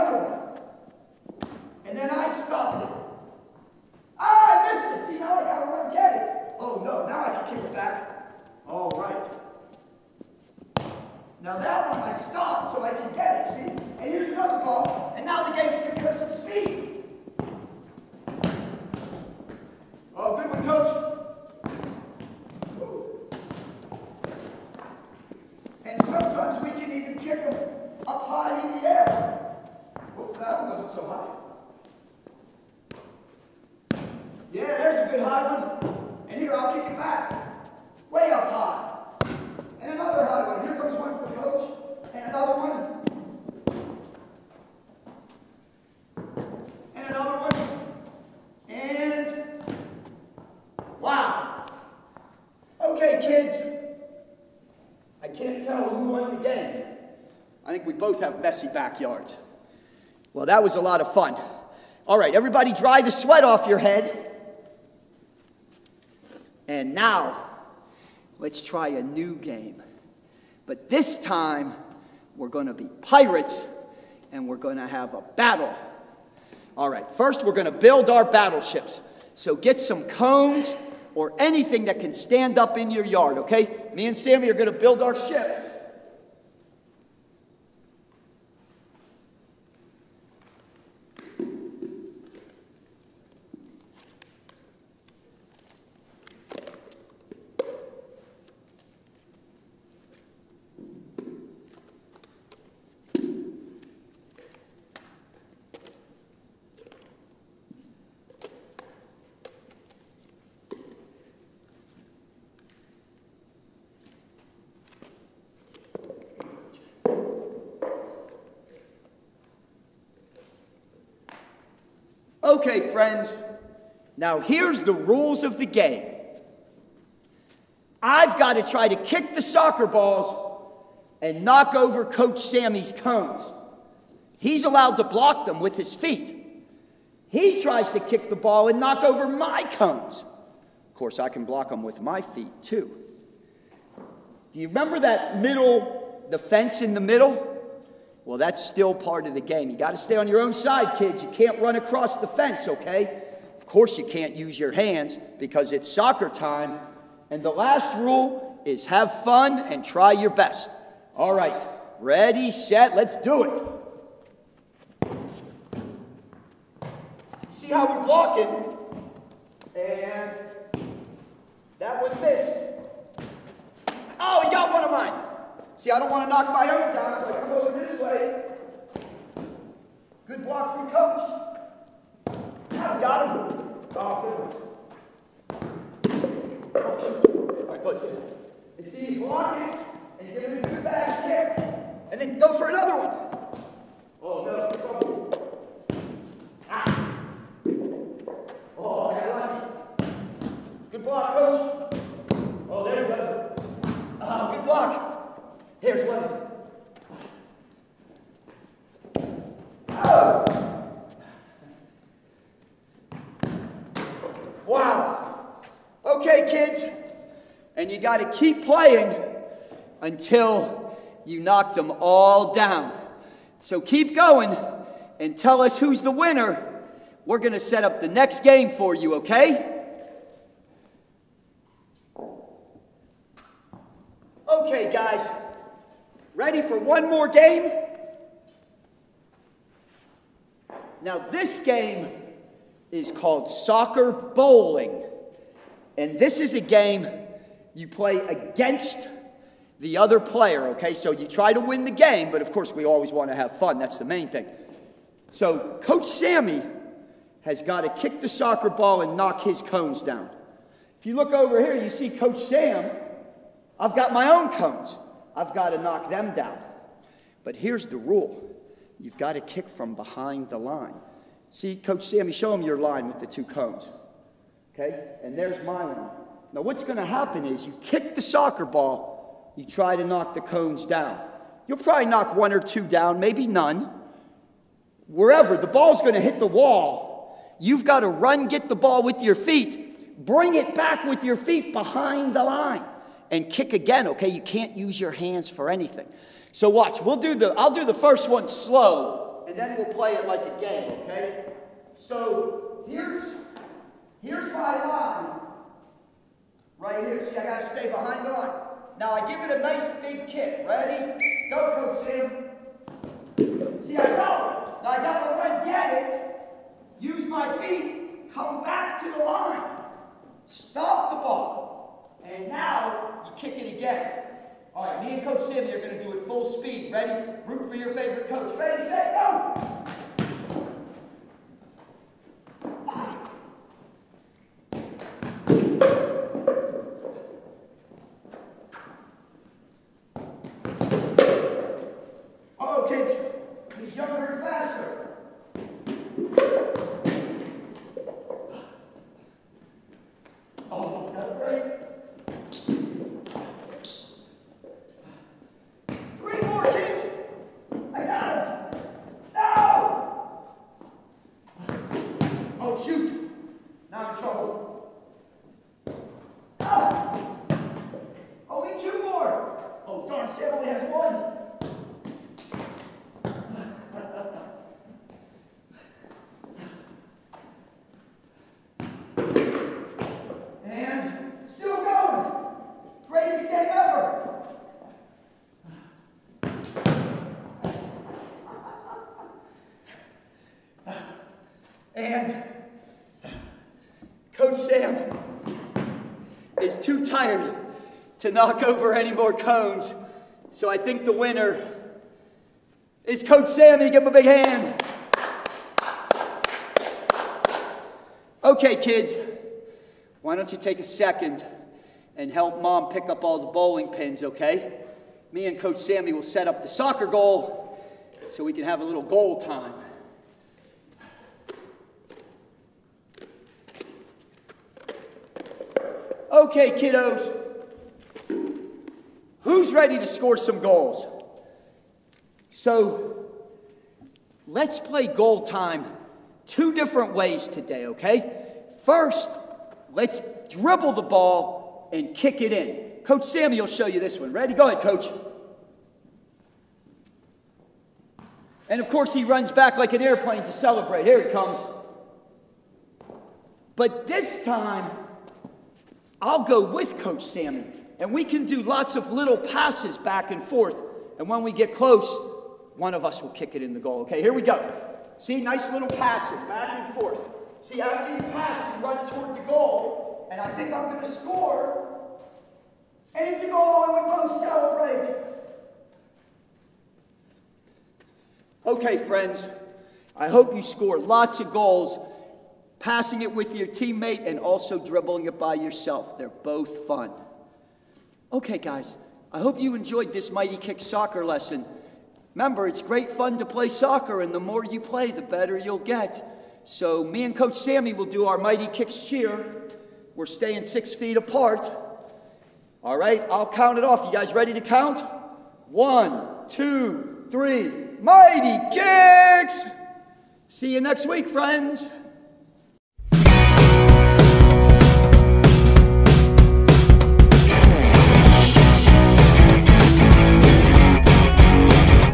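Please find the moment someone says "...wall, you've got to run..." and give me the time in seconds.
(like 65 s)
286 s.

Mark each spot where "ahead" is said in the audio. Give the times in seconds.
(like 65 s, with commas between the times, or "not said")
444 s.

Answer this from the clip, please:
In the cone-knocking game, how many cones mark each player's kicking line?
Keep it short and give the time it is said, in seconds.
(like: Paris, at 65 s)
2, at 273 s.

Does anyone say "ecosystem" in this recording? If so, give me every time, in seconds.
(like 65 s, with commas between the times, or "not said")
not said.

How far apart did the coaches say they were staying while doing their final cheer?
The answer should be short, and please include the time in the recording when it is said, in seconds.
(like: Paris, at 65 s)
6 feet, at 500 s.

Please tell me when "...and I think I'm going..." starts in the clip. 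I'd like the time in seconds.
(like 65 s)
470 s.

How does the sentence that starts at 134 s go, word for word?
He's allowed to block them with his feet.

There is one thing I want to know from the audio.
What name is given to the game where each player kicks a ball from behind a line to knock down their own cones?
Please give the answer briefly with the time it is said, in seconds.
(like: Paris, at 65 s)
Soccer bowling, at 243 s.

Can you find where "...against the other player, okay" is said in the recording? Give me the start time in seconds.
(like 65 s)
248 s.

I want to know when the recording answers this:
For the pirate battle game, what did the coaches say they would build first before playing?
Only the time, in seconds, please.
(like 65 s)
78 s.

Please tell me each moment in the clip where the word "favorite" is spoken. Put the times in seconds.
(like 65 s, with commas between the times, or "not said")
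327 s.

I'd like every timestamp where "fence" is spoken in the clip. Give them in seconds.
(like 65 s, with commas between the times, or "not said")
146 s, 152 s.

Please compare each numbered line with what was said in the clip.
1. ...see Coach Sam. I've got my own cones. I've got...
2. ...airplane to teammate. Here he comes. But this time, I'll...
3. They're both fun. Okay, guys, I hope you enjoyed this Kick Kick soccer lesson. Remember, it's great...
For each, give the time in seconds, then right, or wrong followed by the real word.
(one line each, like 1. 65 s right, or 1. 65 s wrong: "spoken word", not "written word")
1. 261 s right
2. 450 s wrong: "celebrate", not "teammate"
3. 486 s wrong: "Mighty", not "Kick".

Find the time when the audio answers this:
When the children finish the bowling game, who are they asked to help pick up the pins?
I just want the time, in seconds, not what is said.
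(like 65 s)
412 s.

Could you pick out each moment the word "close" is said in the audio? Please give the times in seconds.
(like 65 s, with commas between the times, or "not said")
187 s, 461 s.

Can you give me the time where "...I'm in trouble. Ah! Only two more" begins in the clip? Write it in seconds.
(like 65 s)
364 s.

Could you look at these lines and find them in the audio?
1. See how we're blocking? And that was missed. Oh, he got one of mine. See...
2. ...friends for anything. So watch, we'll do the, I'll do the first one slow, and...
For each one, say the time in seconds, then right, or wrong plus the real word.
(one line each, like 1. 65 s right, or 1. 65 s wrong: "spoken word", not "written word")
1. 167 s right
2. 295 s wrong: "hands", not "friends".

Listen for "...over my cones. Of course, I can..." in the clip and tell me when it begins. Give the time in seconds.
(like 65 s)
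139 s.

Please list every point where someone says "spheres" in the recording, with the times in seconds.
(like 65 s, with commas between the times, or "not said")
not said.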